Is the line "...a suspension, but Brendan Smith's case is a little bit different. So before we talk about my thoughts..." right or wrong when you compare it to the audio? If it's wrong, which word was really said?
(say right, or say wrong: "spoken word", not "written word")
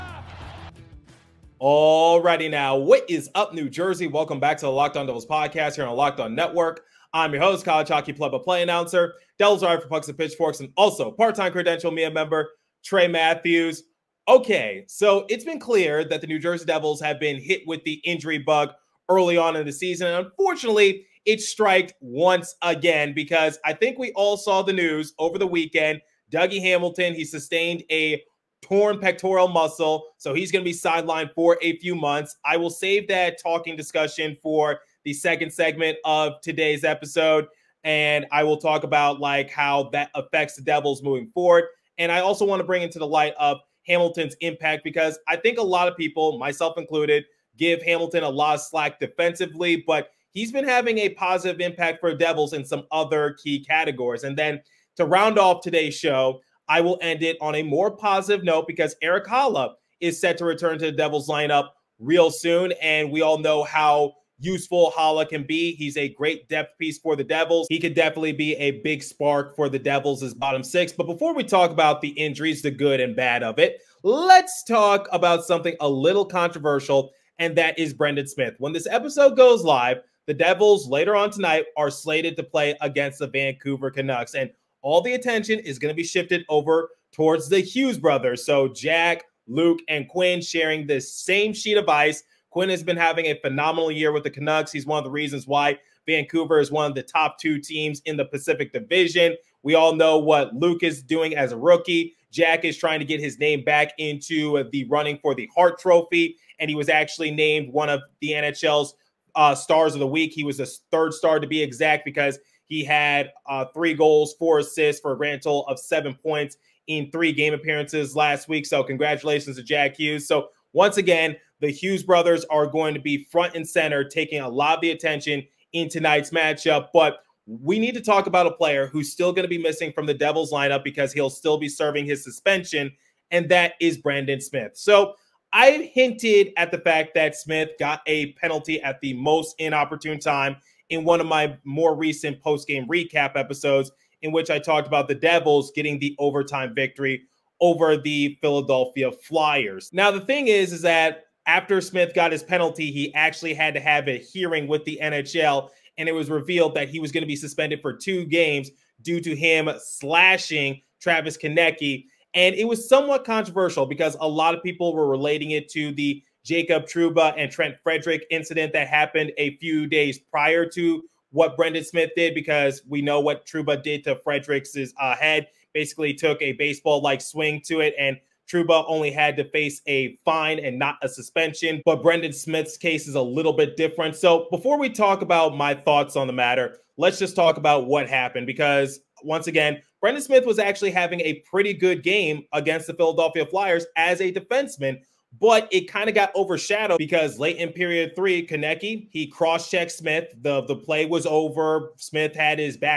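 right.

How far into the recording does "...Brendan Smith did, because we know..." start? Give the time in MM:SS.
02:51.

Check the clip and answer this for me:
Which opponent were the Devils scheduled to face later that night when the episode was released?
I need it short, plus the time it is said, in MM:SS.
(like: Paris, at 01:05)
Vancouver Canucks, at 01:23.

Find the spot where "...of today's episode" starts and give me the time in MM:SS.
00:36.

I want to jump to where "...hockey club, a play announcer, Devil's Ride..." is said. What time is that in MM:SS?
00:07.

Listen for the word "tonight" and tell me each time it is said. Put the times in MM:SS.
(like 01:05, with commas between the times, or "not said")
01:21, 02:05.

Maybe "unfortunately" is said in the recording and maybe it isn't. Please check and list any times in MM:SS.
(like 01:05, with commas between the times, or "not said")
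00:20.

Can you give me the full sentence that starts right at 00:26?
Dougie Hamilton, he sustained a torn pectoral muscle.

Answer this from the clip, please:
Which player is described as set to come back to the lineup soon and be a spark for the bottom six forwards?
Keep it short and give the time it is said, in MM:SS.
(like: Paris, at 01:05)
Erik Haula, at 00:59.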